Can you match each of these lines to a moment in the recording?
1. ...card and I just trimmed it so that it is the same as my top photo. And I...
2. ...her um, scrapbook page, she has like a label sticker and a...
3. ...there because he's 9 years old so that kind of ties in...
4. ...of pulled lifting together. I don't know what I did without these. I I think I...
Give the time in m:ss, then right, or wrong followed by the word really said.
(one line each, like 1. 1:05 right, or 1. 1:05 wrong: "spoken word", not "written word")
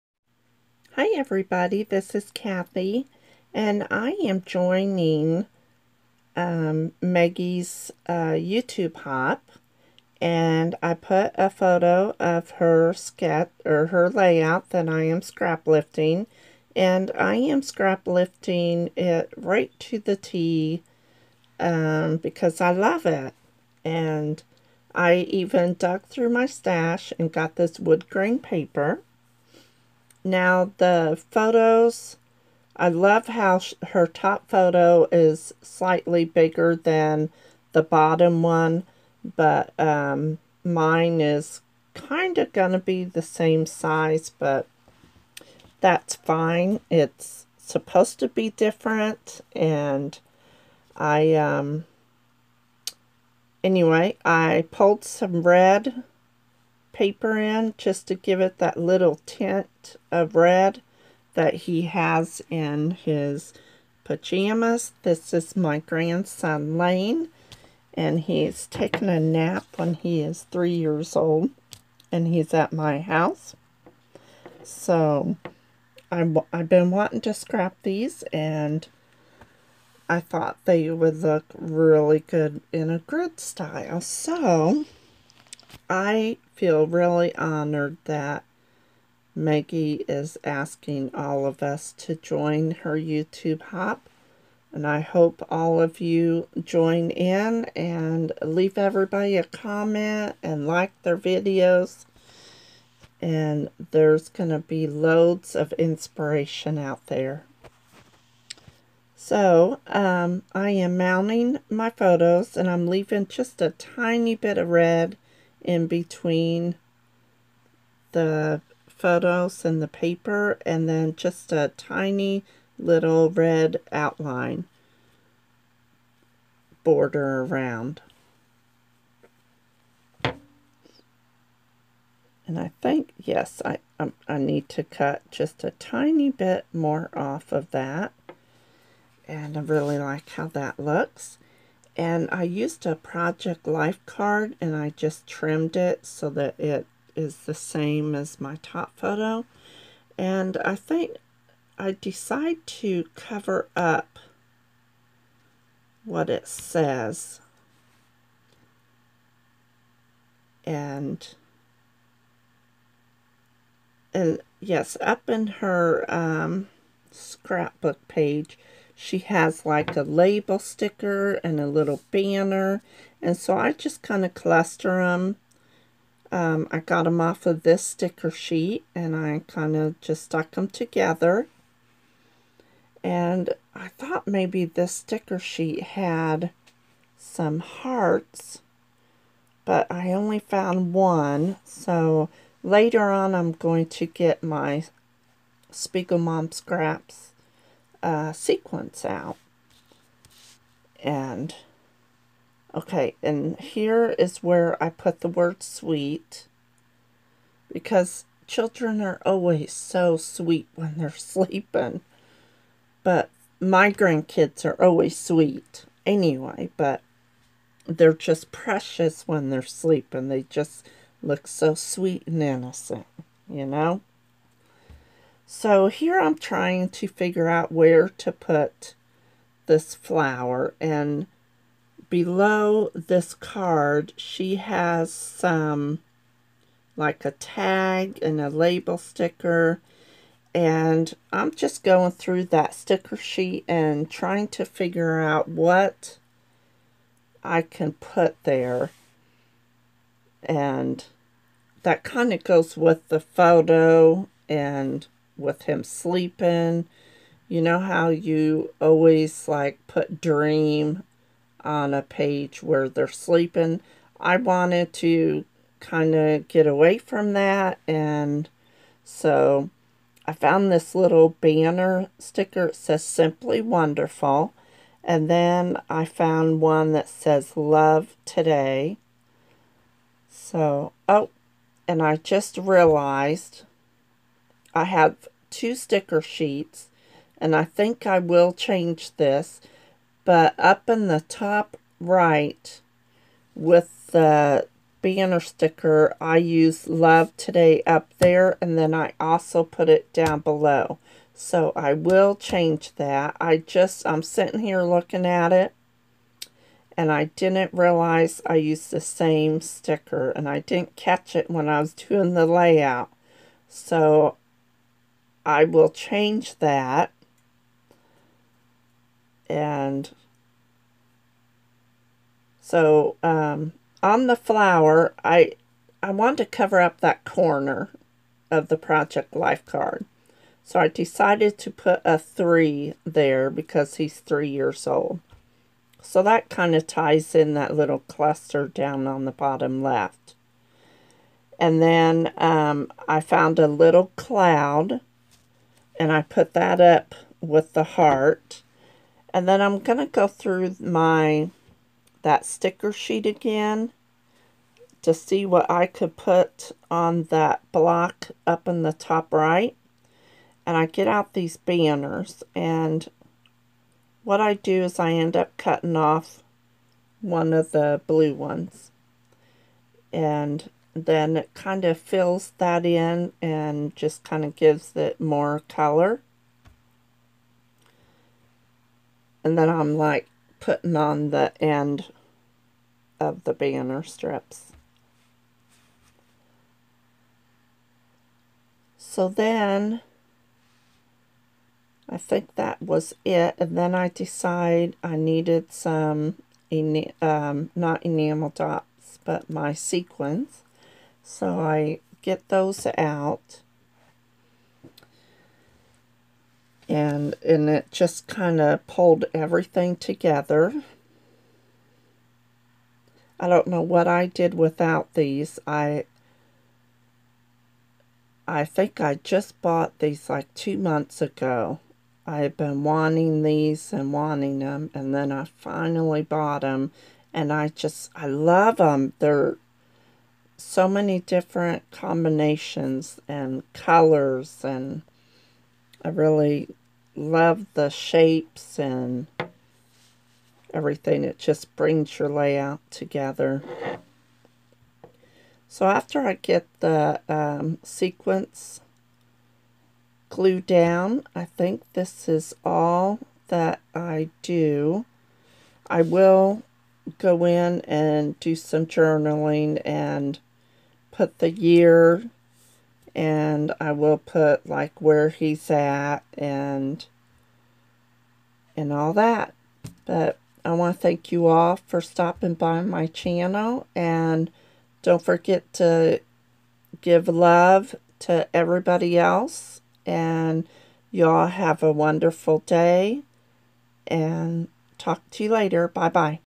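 1. 2:24 right
2. 2:45 right
3. 5:33 wrong: "3", not "9"
4. 6:48 wrong: "everything", not "lifting".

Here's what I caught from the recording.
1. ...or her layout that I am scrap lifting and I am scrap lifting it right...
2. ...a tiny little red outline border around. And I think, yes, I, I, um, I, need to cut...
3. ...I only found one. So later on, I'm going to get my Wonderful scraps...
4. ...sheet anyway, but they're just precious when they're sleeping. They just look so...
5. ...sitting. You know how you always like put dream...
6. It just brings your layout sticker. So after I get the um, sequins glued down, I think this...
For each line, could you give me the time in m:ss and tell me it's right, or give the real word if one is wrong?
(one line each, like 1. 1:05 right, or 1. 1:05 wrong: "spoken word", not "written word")
1. 0:13 right
2. 2:01 right
3. 3:09 wrong: "Mom", not "Wonderful"
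4. 3:35 wrong: "sweet", not "sheet"
5. 4:15 wrong: "sleeping", not "sitting"
6. 7:21 wrong: "together", not "sticker".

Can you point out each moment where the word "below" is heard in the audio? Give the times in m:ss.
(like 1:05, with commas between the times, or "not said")
3:52, 5:00.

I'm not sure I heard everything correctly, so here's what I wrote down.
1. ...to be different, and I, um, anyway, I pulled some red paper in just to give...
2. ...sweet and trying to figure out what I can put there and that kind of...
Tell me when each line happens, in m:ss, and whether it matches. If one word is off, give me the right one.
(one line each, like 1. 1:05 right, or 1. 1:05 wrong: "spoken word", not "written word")
1. 0:48 right
2. 4:03 wrong: "sheet", not "sweet".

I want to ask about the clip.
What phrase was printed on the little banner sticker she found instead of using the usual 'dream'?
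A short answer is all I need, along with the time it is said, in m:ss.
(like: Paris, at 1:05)
Simply Wonderful, at 4:33.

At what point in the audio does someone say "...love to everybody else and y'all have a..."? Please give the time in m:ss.
7:57.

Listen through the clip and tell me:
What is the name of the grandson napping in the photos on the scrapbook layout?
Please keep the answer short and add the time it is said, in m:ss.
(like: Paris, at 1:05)
Lane, at 1:06.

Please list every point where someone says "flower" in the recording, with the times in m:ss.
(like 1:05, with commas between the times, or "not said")
3:49, 5:24.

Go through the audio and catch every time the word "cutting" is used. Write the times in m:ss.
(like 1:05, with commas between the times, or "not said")
6:05.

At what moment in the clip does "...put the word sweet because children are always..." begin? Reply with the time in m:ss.
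3:24.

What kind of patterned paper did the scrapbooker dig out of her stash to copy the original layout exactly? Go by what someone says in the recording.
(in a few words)
wood grain paper.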